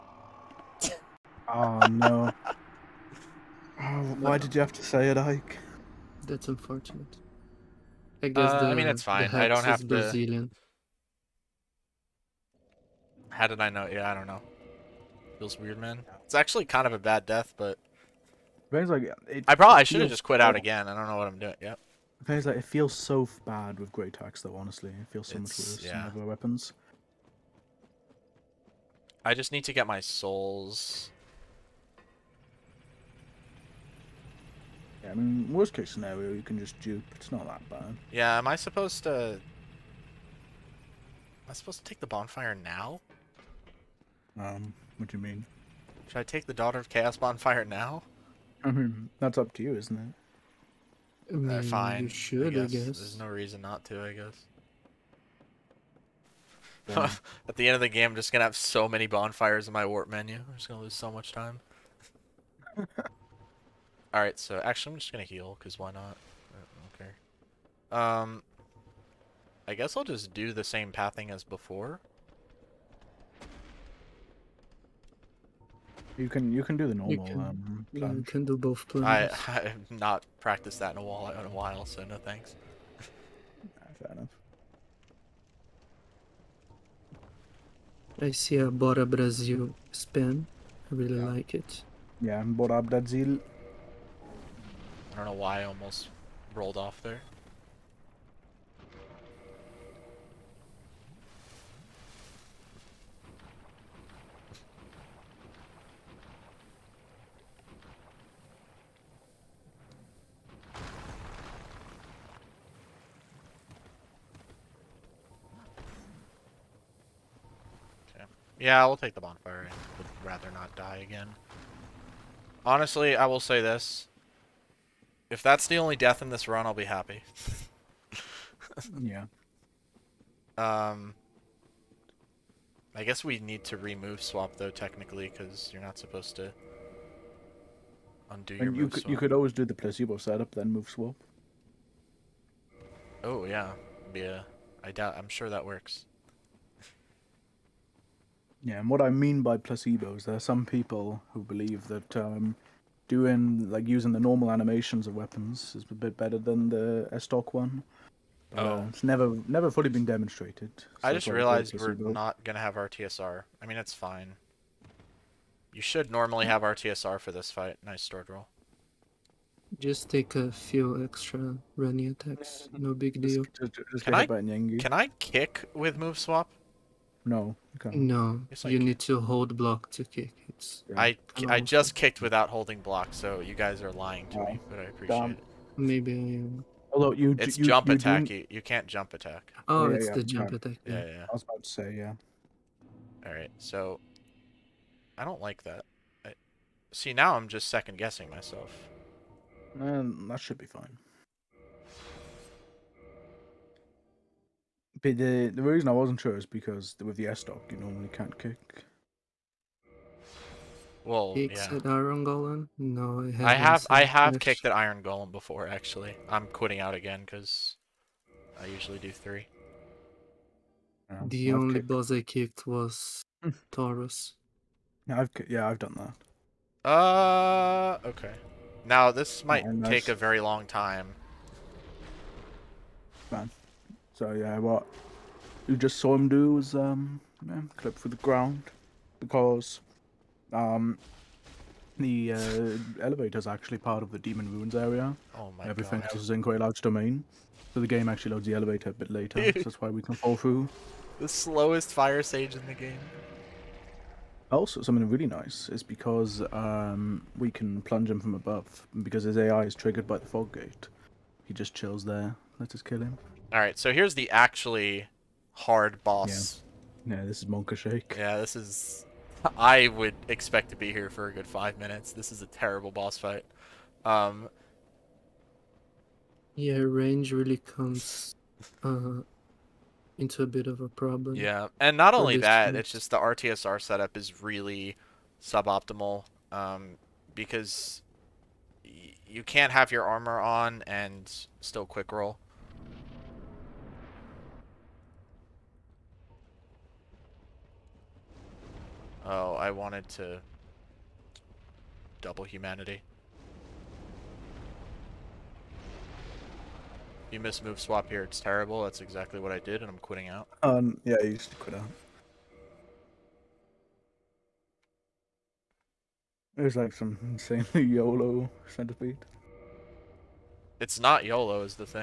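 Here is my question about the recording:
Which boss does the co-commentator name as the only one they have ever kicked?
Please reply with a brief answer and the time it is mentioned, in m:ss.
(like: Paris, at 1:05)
Taurus, at 3:43.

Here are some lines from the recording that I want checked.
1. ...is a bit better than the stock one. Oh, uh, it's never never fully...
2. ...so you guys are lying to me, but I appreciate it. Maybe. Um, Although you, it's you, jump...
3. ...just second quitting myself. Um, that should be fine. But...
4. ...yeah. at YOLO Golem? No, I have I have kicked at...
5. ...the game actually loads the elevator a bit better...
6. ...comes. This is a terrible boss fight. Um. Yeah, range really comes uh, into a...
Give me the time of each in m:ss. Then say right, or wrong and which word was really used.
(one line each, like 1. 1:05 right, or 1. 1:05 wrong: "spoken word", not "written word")
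1. 2:35 right
2. 3:03 right
3. 3:17 wrong: "guessing", not "quitting"
4. 3:31 wrong: "Iron", not "YOLO"
5. 4:07 wrong: "later", not "better"
6. 4:31 wrong: "minutes", not "comes".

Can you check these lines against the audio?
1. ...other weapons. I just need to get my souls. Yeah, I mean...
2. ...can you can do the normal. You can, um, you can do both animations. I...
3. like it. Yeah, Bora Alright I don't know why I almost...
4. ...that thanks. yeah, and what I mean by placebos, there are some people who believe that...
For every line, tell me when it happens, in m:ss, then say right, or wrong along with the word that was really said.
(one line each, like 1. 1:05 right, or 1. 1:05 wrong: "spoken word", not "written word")
1. 0:26 right
2. 1:16 wrong: "plans", not "animations"
3. 1:31 wrong: "Brazil", not "Alright"
4. 2:25 wrong: "works", not "thanks".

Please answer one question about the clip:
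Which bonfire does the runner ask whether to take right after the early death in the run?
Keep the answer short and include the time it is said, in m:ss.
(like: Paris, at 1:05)
Daughter of Chaos, at 0:46.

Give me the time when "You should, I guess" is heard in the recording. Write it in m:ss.
0:52.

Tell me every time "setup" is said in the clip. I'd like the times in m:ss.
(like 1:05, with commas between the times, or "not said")
2:20, 4:43.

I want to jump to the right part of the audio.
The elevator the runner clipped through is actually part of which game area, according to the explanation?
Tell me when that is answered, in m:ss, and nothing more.
4:04.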